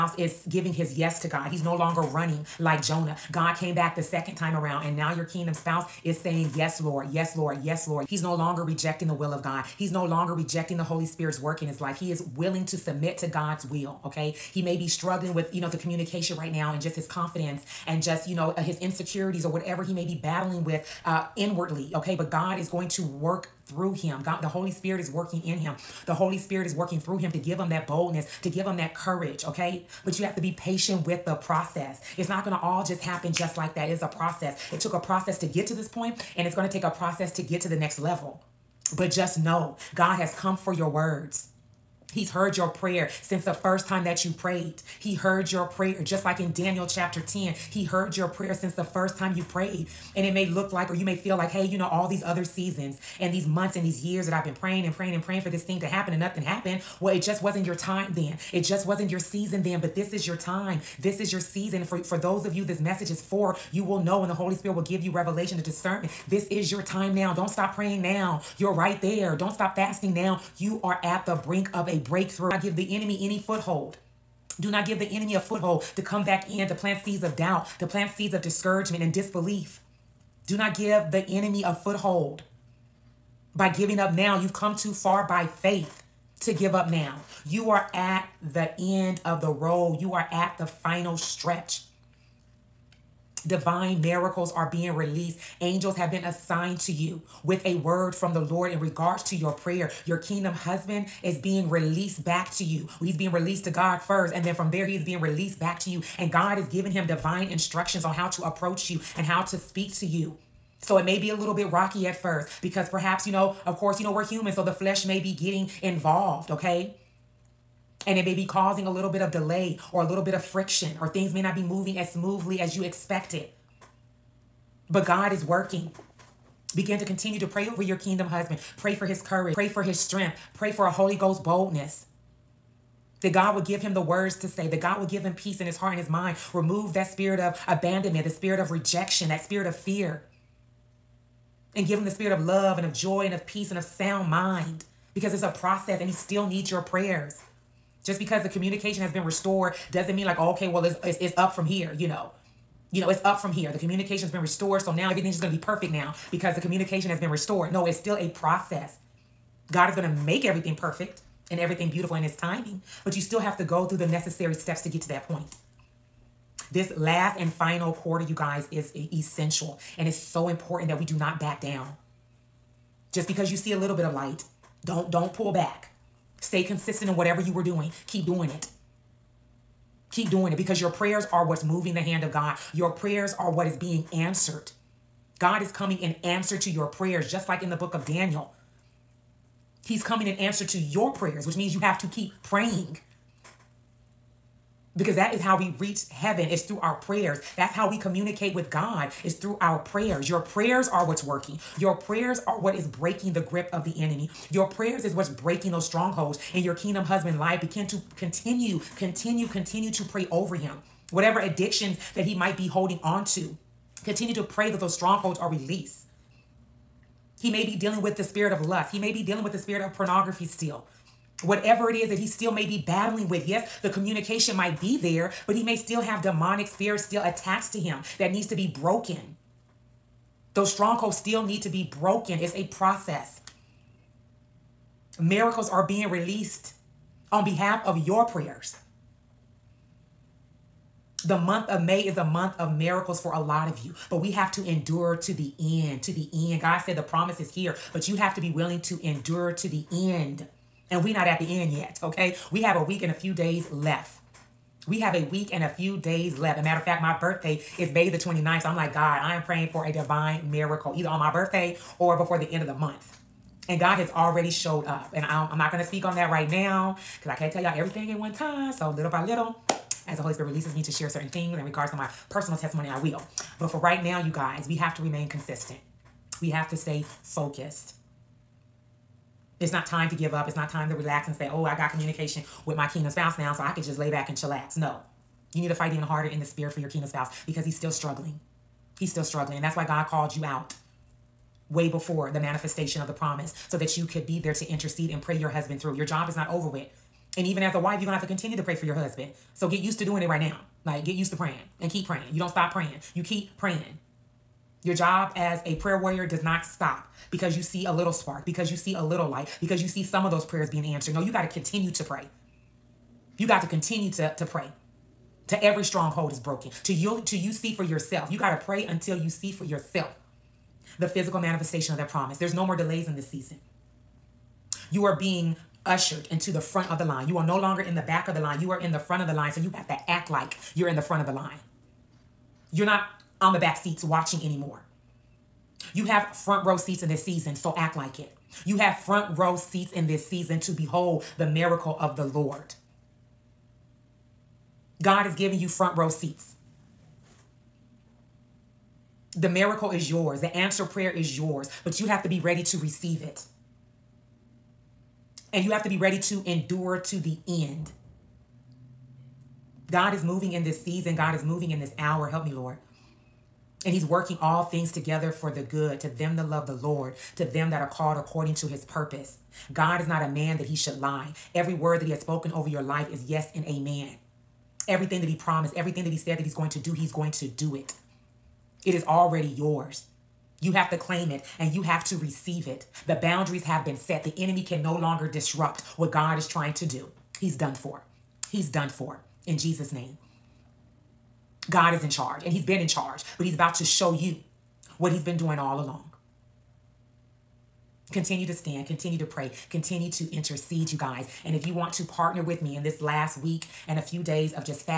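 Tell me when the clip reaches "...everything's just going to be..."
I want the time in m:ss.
2:35.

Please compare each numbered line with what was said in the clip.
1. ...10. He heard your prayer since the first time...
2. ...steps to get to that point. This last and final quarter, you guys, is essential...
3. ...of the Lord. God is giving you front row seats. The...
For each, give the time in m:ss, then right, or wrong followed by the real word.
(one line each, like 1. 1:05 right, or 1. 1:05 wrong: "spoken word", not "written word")
1. 0:47 right
2. 2:44 right
3. 5:41 right.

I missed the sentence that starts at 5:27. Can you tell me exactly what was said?
You are no longer in the back of the line.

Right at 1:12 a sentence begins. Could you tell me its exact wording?
I give the enemy any foothold.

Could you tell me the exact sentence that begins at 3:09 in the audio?
He's coming in answer to your prayers, which means you have to keep praying.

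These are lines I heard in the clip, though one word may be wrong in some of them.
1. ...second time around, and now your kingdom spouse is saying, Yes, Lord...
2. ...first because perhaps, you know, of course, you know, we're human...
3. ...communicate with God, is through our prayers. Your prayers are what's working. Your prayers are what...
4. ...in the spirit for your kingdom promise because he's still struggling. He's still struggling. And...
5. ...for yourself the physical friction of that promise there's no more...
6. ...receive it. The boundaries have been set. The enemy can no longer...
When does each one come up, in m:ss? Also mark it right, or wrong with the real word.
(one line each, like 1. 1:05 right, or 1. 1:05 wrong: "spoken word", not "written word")
1. 0:04 right
2. 1:52 right
3. 3:17 right
4. 4:46 wrong: "spouse", not "promise"
5. 5:19 wrong: "manifestation", not "friction"
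6. 6:22 right.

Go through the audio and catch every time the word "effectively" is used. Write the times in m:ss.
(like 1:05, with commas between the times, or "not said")
not said.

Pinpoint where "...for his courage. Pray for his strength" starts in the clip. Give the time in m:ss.
2:08.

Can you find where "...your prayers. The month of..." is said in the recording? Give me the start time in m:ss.
3:58.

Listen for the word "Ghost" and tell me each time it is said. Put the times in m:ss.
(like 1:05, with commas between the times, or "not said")
2:11.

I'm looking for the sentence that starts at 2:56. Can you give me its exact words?
Stay consistent in whatever you were doing.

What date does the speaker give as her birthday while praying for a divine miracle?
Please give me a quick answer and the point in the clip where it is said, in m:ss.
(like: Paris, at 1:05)
May 29, at 4:17.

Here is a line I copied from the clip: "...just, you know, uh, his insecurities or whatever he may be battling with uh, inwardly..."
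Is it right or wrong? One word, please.
right.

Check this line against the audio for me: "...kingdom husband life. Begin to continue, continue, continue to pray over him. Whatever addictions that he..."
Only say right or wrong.
right.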